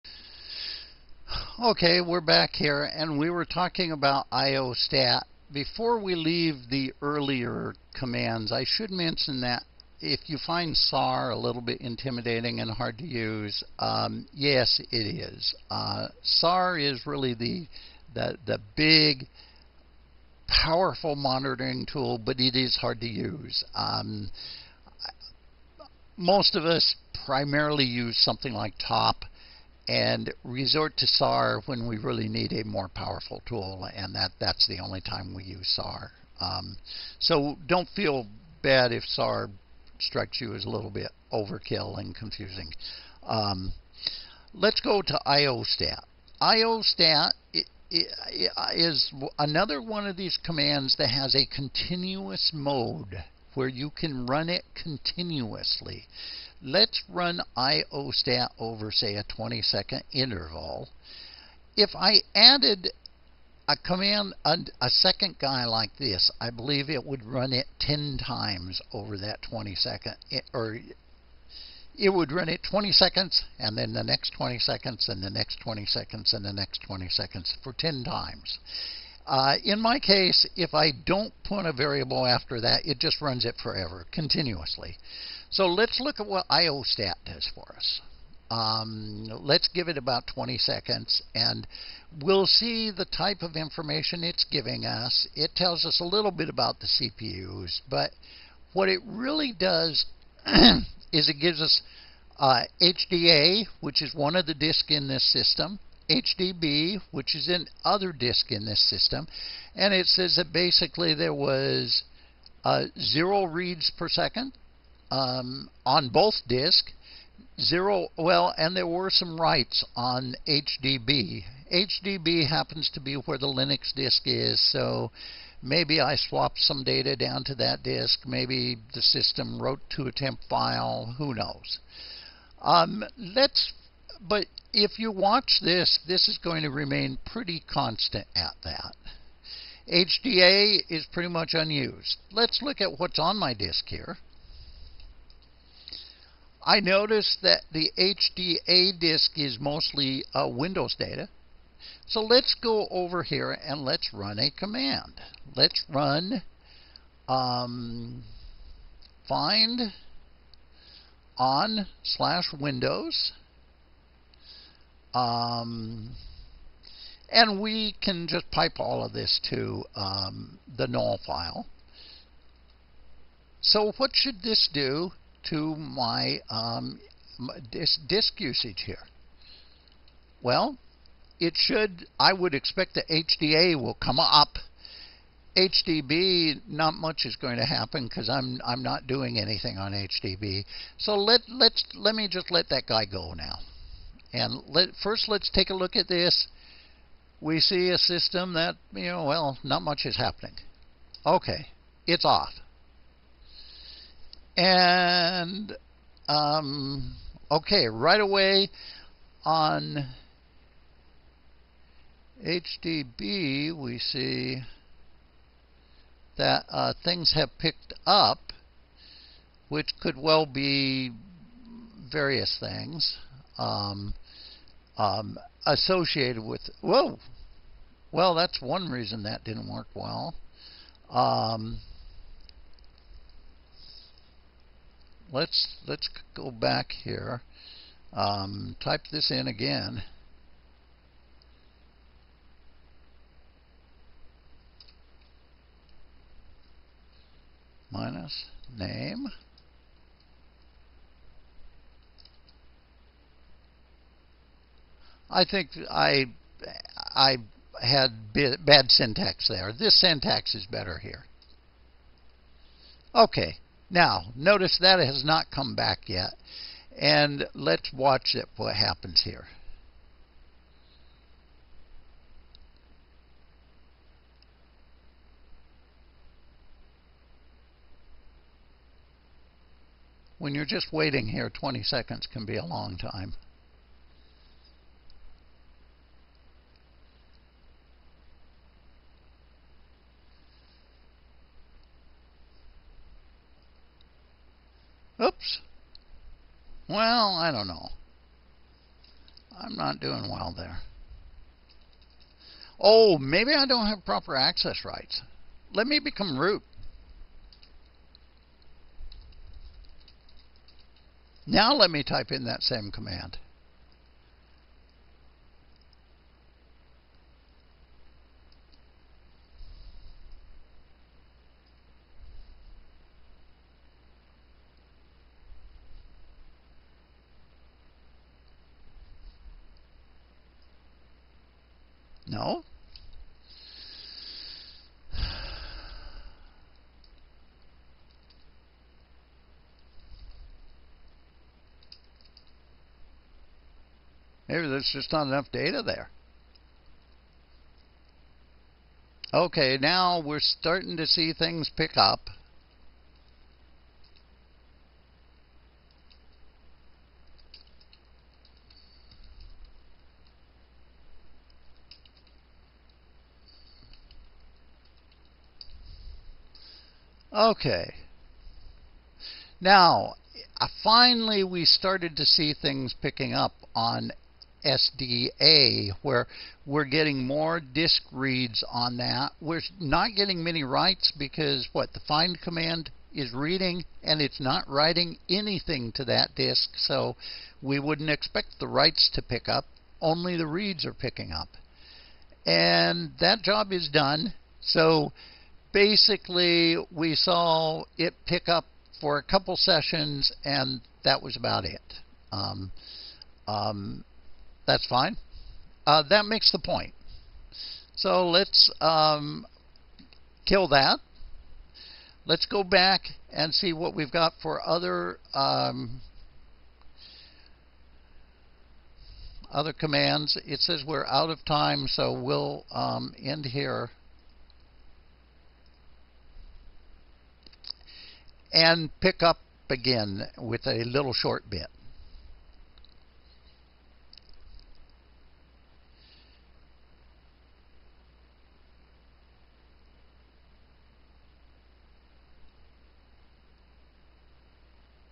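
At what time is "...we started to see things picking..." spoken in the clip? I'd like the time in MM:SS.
06:11.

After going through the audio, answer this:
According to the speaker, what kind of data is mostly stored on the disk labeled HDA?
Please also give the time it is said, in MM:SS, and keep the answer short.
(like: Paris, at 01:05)
Windows data, at 02:30.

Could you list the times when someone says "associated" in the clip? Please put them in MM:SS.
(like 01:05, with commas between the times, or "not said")
03:45.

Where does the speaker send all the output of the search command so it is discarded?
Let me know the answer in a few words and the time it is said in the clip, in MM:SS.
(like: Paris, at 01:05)
the null file, at 02:50.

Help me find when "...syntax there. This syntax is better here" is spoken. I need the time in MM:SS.
04:18.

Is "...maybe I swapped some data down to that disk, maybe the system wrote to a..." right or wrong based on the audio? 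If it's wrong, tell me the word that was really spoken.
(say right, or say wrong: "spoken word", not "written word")
right.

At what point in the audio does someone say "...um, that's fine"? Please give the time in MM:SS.
06:43.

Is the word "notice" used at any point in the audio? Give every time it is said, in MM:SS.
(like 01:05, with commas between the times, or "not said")
02:26, 04:24.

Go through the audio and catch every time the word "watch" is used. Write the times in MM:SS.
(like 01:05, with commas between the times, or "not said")
02:15, 04:27.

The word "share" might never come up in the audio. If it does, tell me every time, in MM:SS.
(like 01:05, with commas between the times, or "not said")
not said.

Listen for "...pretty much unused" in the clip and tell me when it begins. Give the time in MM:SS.
02:21.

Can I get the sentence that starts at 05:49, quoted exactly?
Okay, now we're starting to see things pick up.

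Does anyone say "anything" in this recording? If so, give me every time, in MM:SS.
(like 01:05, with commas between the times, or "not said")
03:09, 06:25.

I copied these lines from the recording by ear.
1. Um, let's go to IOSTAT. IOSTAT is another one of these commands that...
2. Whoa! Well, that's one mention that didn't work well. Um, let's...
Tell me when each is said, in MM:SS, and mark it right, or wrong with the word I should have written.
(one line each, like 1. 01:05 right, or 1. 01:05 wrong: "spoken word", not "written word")
1. 00:43 right
2. 03:46 wrong: "reason", not "mention".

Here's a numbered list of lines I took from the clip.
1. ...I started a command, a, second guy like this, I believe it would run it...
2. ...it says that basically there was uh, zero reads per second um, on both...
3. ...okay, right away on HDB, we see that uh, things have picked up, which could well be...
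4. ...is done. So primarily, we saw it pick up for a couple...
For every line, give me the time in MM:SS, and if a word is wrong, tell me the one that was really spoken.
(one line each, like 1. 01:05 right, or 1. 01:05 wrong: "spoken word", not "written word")
1. 01:01 wrong: "added", not "started"
2. 01:49 right
3. 03:27 right
4. 06:33 wrong: "basically", not "primarily".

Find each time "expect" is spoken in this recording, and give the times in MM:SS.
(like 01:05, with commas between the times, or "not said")
03:02, 06:28.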